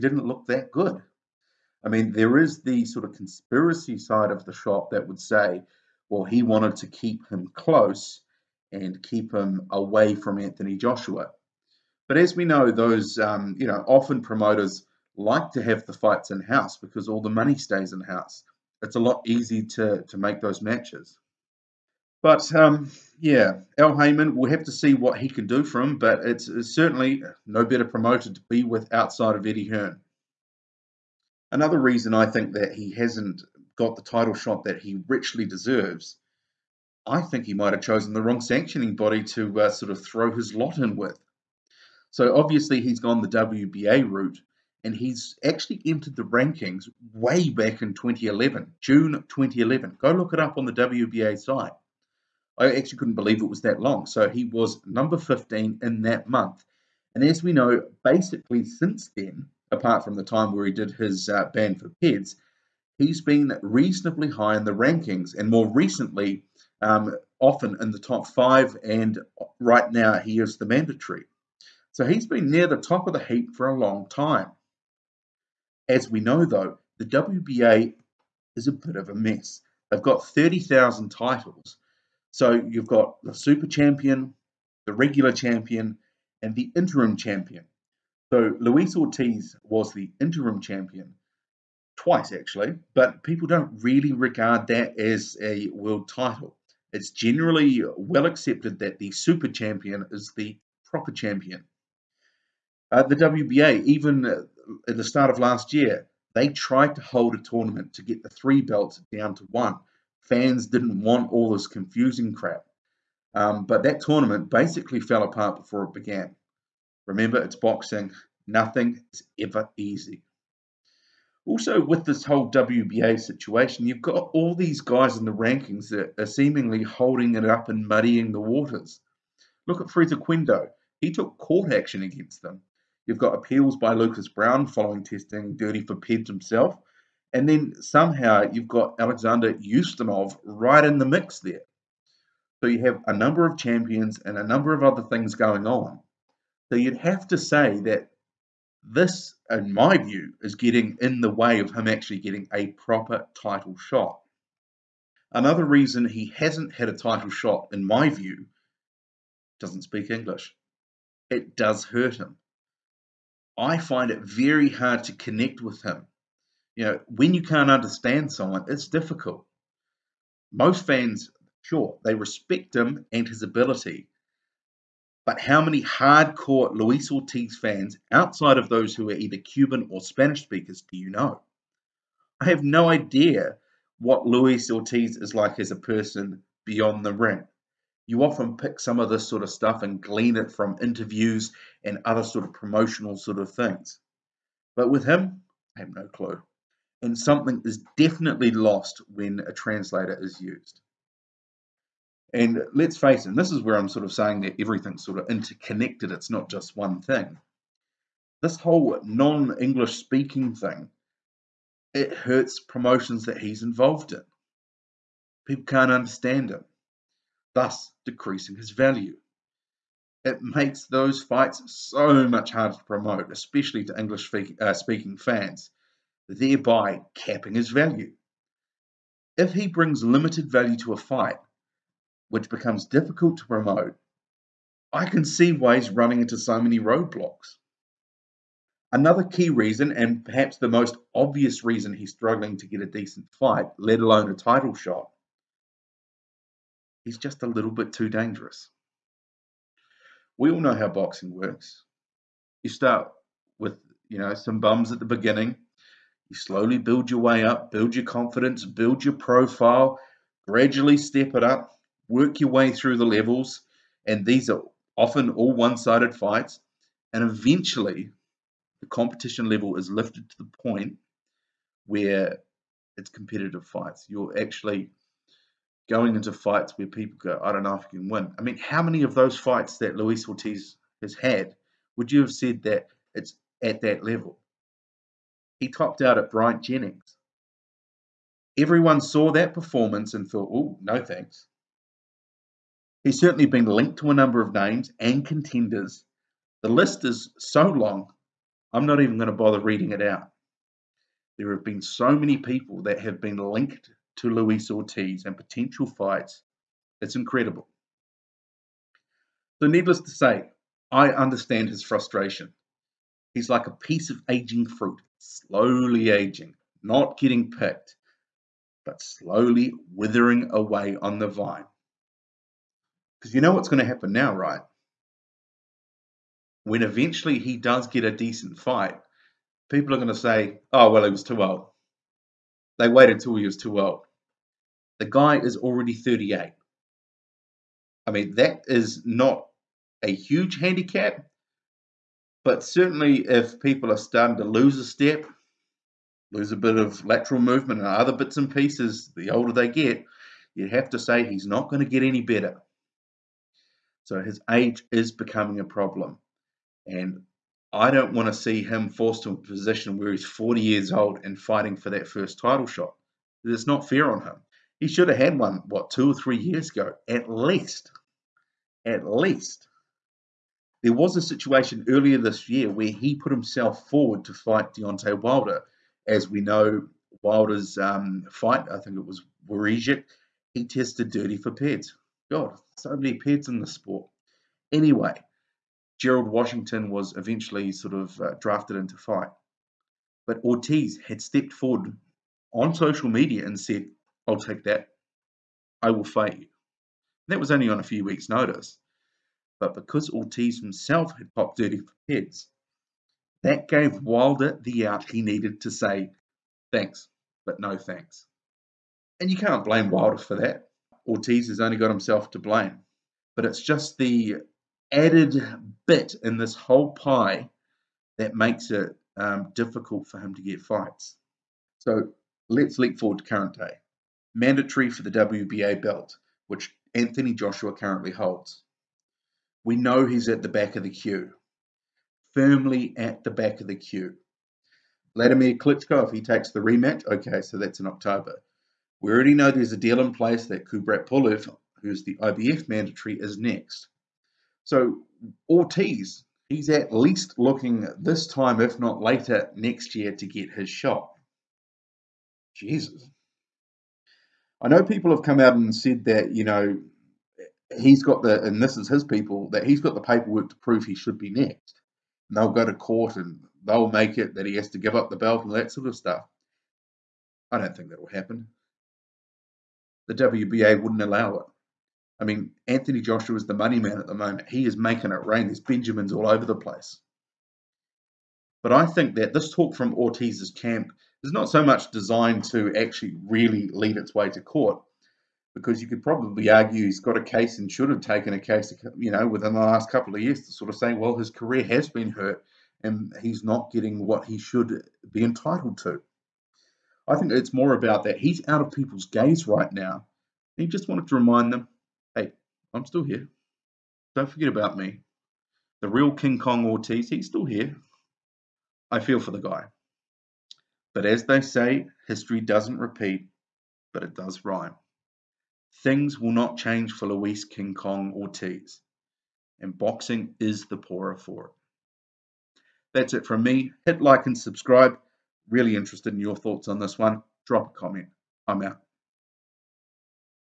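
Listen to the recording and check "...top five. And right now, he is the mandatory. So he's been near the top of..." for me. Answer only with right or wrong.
right.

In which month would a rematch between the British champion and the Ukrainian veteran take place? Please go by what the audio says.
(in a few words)
October.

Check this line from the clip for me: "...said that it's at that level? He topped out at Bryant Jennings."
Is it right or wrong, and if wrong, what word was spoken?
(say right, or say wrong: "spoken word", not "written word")
right.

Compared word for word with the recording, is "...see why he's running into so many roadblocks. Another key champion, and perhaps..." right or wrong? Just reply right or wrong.
wrong.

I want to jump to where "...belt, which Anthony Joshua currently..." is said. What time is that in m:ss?
7:05.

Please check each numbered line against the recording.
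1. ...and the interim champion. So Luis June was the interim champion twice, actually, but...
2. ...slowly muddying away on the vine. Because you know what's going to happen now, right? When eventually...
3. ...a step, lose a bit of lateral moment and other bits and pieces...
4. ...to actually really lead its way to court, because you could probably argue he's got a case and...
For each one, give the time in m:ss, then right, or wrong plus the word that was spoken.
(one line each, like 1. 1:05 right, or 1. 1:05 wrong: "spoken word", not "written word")
1. 1:26 wrong: "Ortiz", not "June"
2. 5:19 wrong: "withering", not "muddying"
3. 5:44 wrong: "movement", not "moment"
4. 8:02 right.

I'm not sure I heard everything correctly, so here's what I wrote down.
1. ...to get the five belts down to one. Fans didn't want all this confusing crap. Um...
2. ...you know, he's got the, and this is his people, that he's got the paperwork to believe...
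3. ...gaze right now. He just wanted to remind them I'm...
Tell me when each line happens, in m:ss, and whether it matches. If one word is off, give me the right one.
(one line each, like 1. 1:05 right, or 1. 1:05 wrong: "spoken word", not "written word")
1. 1:47 wrong: "three", not "five"
2. 7:36 wrong: "prove", not "believe"
3. 8:19 right.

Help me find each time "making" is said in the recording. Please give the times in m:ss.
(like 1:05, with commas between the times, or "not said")
7:54.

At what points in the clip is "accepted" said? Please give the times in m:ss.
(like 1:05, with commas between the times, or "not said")
1:38.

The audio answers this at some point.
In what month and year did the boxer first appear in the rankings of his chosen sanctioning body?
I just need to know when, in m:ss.
0:48.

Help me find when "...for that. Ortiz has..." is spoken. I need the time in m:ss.
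6:50.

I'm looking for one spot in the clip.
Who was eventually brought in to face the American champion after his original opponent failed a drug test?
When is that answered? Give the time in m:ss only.
6:26.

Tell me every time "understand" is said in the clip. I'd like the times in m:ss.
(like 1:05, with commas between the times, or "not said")
2:47, 3:35, 5:11.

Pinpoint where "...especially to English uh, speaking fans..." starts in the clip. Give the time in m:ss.
3:43.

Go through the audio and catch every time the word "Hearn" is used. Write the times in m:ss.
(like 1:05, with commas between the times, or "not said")
0:29.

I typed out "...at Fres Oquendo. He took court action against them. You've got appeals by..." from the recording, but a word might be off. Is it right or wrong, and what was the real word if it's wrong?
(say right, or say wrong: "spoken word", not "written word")
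right.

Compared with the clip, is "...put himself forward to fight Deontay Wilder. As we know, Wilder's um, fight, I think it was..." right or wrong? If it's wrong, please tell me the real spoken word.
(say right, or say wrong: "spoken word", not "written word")
right.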